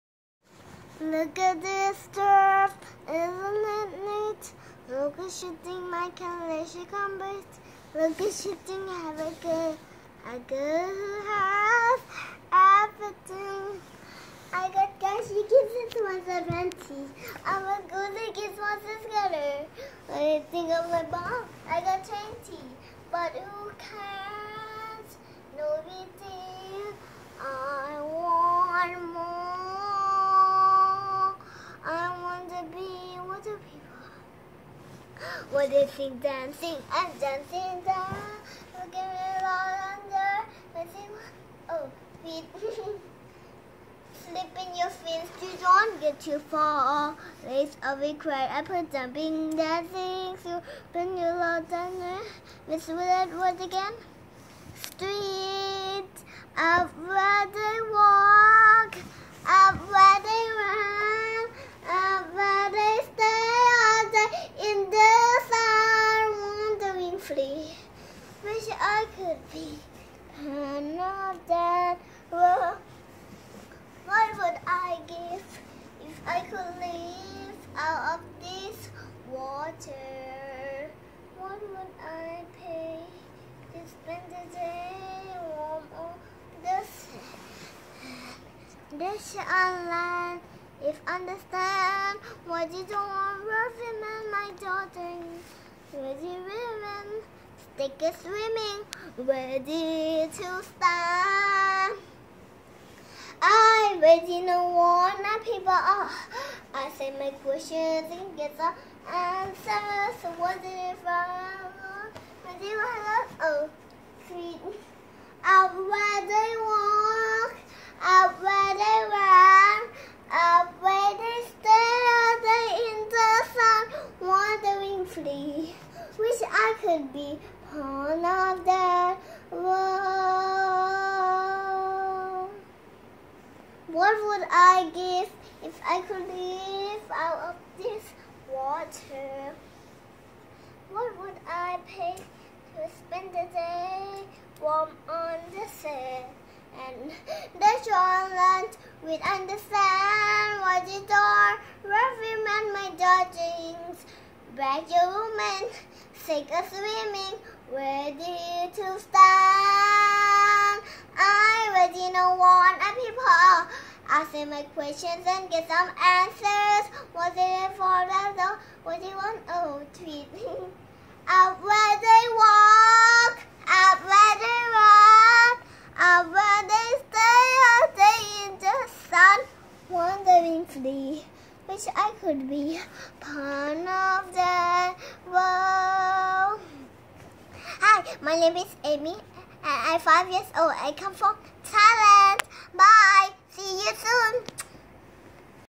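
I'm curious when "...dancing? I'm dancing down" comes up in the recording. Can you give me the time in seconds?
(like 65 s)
36 s.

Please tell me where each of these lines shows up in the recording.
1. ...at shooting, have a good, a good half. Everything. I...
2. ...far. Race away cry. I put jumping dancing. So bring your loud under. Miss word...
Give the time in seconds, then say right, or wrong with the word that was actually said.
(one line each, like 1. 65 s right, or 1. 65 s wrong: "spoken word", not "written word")
1. 8 s right
2. 46 s right.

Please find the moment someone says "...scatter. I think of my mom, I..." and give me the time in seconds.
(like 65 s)
19 s.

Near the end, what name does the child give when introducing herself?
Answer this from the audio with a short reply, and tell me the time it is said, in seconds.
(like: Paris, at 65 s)
Amy, at 188 s.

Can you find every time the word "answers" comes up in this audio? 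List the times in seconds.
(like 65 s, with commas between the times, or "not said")
109 s, 165 s.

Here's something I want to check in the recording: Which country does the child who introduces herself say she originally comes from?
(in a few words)
Thailand.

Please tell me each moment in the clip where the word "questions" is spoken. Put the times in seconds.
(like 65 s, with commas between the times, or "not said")
107 s, 164 s.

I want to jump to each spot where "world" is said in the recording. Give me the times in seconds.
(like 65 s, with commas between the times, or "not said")
129 s.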